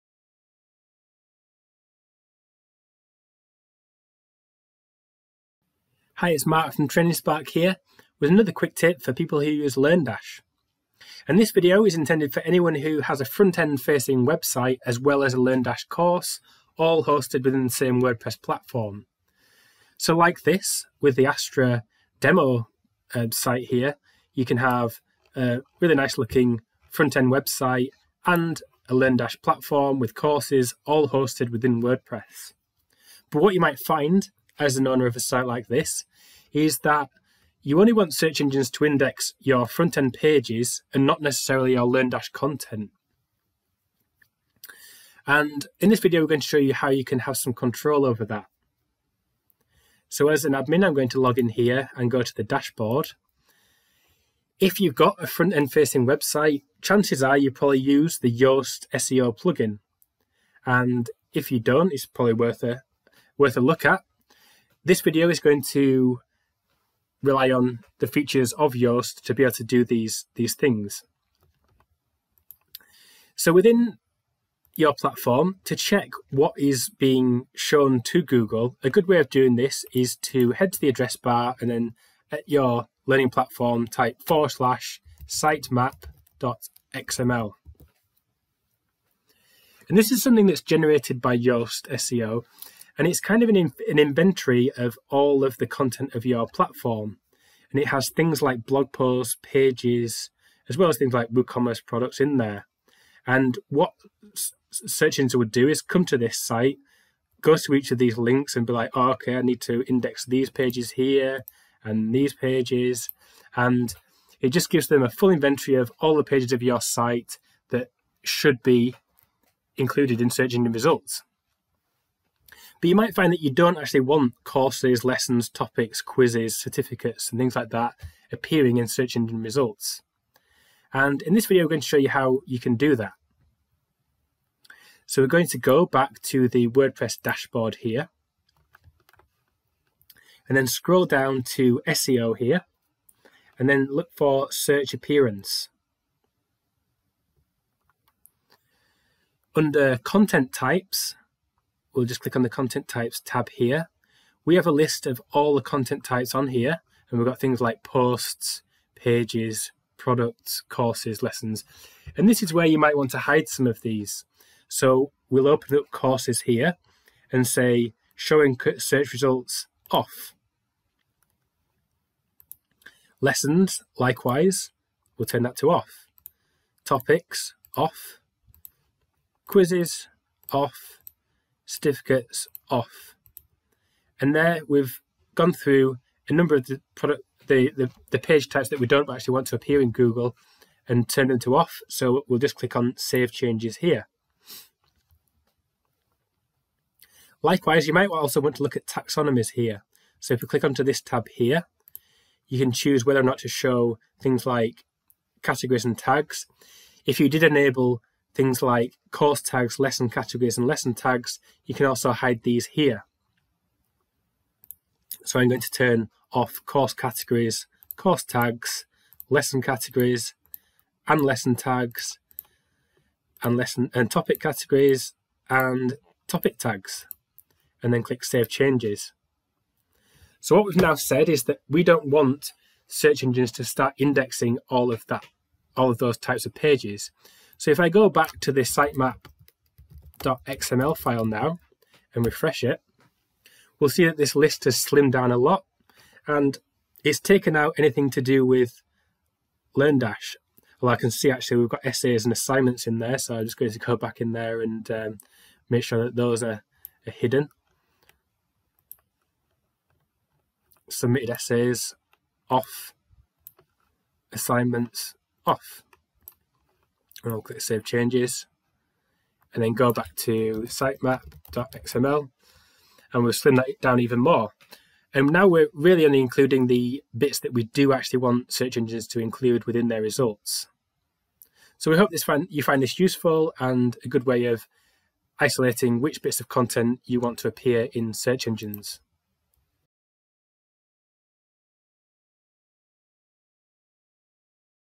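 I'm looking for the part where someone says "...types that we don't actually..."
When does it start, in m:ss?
3:08.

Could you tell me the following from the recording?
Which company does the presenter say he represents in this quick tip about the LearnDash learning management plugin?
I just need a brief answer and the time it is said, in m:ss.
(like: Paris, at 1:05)
Training Spark, at 0:06.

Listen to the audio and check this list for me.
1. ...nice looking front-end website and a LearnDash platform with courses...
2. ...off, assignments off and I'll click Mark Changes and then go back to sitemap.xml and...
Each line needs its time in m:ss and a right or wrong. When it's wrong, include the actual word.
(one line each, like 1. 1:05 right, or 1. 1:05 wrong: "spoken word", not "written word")
1. 0:25 right
2. 4:22 wrong: "Save", not "Mark".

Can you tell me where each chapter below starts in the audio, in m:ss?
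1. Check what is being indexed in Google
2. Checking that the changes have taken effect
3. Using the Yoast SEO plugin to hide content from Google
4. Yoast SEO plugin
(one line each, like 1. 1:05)
1. 1:25
2. 3:57
3. 2:16
4. 0:50.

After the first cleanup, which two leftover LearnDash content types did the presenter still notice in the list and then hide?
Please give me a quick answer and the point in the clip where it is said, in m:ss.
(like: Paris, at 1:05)
Essays and assignments, at 4:11.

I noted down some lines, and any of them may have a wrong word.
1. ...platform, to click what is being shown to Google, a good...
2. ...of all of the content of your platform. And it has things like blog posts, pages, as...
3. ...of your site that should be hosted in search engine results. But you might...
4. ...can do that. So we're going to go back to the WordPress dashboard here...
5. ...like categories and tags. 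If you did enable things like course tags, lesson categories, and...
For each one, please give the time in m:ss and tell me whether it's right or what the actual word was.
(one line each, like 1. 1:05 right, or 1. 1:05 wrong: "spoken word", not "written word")
1. 1:14 wrong: "check", not "click"
2. 1:34 right
3. 1:56 wrong: "included", not "hosted"
4. 2:12 right
5. 3:24 right.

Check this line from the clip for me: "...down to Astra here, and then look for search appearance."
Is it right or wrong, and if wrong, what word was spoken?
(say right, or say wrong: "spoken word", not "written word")
wrong: "SEO", not "Astra".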